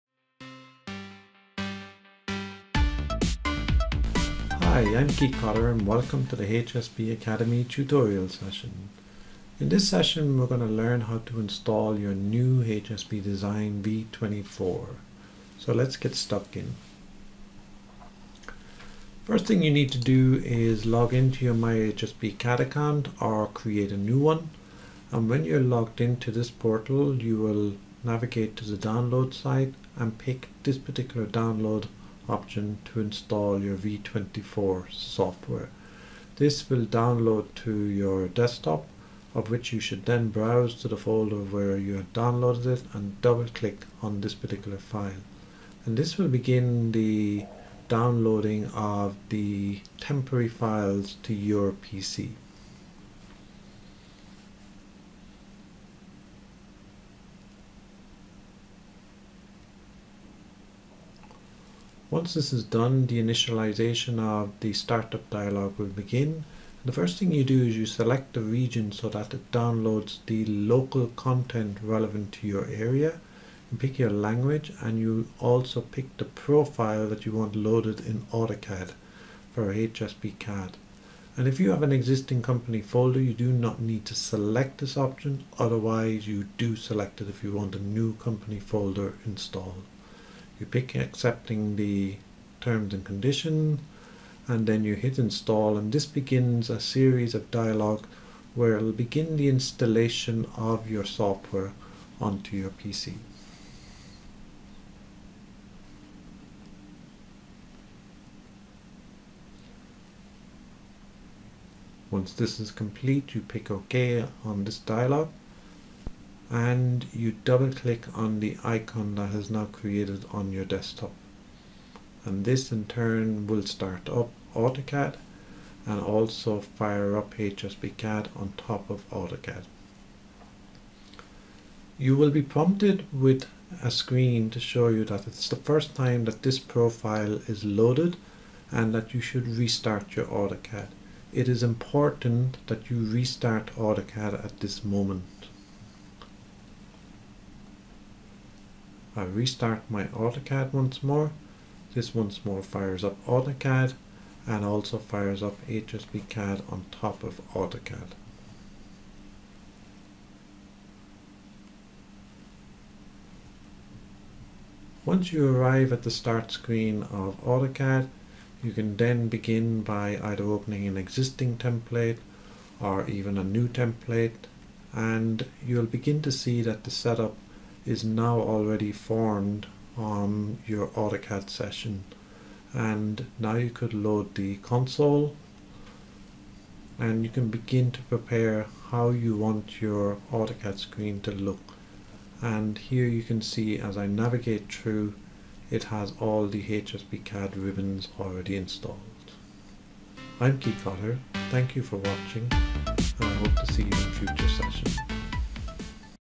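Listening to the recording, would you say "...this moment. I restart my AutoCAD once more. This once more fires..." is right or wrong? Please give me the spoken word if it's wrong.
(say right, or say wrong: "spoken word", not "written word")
right.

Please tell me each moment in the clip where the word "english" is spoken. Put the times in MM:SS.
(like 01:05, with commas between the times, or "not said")
not said.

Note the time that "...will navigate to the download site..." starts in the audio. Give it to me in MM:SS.
00:27.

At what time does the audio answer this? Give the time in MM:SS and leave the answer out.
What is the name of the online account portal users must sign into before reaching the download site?
00:21.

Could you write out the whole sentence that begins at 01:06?
The first thing you do is you select the region so that it downloads the local content relevant to your area.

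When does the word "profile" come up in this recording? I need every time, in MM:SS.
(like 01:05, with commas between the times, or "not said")
01:16, 02:16.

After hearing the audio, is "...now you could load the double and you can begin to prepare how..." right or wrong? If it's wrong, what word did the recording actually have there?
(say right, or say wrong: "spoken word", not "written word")
wrong: "console", not "double".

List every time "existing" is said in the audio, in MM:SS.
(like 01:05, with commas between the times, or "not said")
01:21, 02:50.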